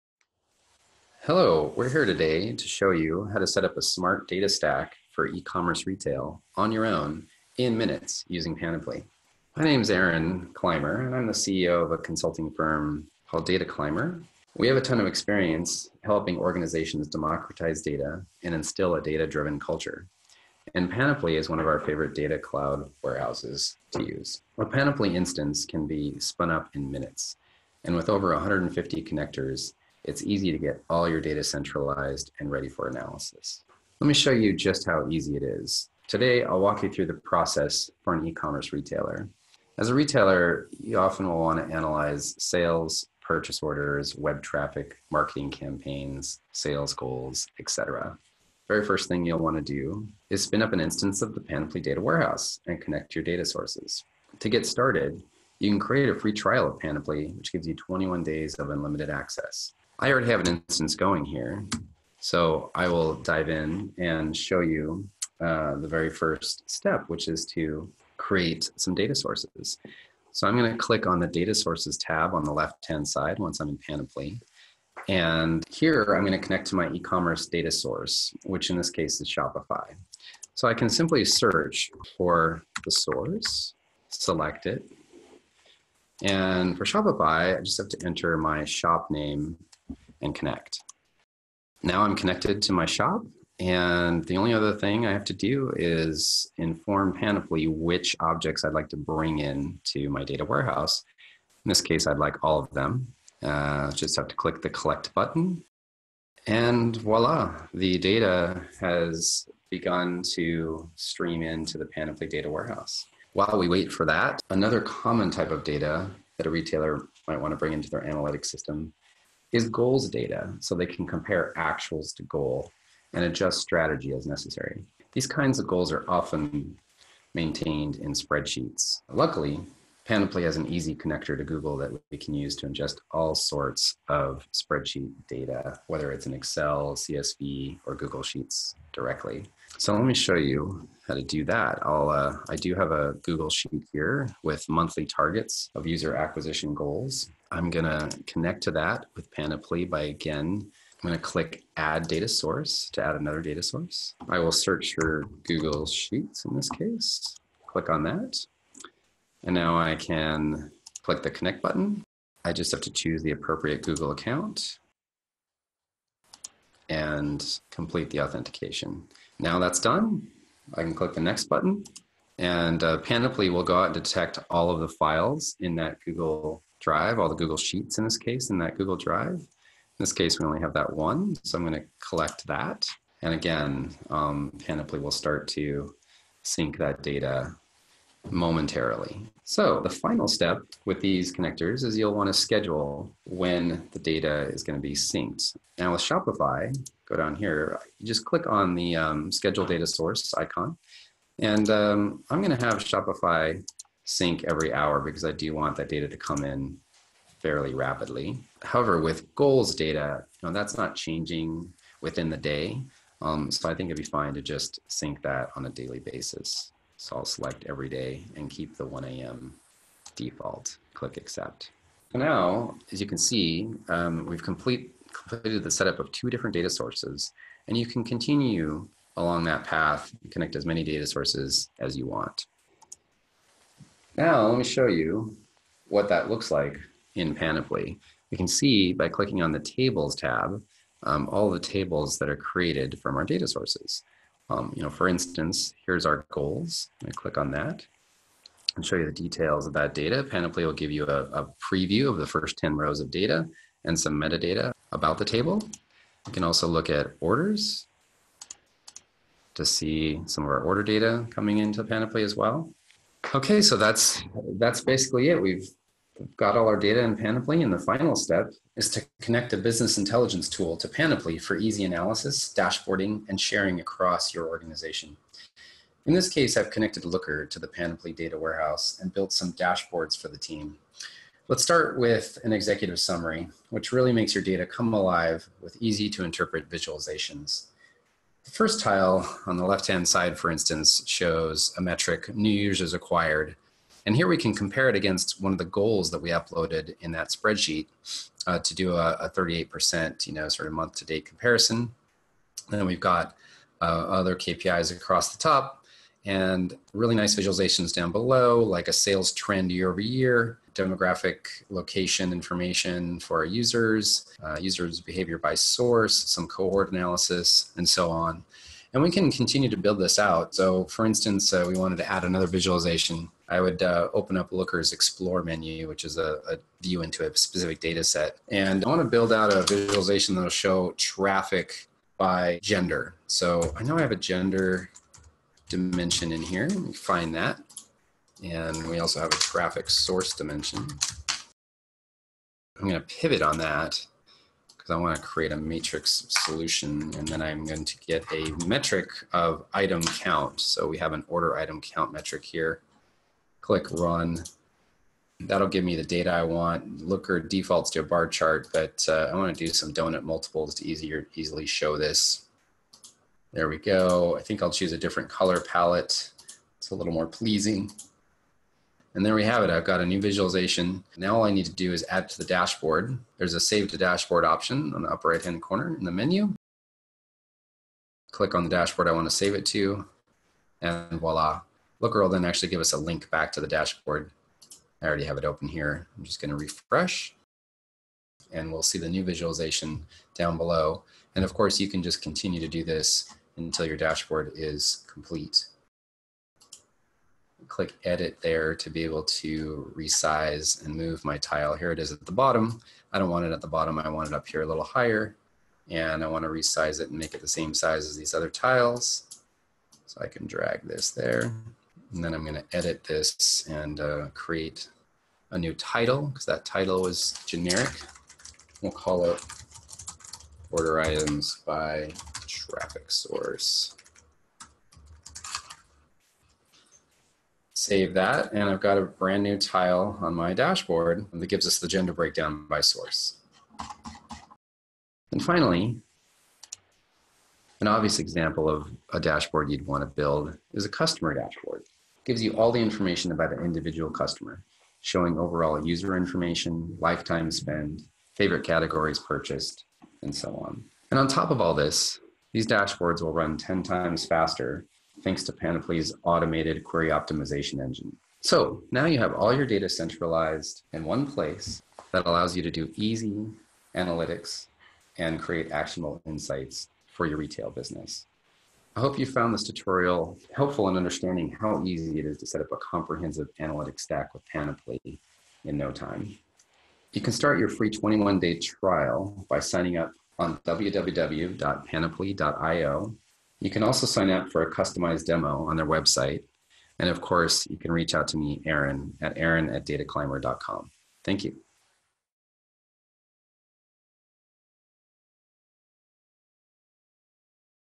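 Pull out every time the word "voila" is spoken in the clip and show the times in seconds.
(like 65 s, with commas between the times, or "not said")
106 s, 381 s.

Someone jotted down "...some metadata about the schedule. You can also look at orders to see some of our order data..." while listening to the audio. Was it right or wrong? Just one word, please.
wrong.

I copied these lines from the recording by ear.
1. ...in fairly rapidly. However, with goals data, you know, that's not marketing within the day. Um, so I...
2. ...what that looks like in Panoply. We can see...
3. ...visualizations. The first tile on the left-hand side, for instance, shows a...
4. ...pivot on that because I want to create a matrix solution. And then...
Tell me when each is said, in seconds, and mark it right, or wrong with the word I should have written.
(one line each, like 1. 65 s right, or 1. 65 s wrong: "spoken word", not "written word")
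1. 206 s wrong: "changing", not "marketing"
2. 235 s right
3. 286 s right
4. 343 s right.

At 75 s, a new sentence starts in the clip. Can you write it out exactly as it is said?
And here I'm going to connect to my e-commerce data source, which in this case is Shopify.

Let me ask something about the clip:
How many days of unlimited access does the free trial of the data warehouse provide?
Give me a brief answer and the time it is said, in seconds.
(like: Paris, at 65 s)
21, at 57 s.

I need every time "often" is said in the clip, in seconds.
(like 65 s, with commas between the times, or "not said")
40 s, 126 s.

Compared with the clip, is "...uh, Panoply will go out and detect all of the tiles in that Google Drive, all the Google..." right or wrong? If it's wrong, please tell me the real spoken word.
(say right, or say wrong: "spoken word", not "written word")
wrong: "files", not "tiles".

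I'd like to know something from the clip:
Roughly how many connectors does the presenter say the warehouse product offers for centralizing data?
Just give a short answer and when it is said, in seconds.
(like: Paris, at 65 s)
150, at 28 s.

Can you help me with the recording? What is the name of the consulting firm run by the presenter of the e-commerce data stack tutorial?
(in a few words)
Data Clymer.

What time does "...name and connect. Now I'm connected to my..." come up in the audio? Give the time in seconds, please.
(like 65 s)
89 s.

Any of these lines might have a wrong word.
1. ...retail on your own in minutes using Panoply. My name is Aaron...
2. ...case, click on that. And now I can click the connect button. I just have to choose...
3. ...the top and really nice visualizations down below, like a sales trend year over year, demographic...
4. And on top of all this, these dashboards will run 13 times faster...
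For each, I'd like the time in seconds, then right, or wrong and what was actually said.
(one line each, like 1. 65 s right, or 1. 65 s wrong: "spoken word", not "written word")
1. 5 s right
2. 156 s right
3. 305 s right
4. 451 s wrong: "10", not "13".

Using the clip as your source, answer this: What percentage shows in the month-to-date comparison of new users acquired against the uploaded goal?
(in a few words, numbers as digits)
38%.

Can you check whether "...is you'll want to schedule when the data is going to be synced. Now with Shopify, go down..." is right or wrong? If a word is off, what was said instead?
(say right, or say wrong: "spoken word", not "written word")
right.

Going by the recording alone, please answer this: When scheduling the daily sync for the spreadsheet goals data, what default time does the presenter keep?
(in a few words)
1 a.m.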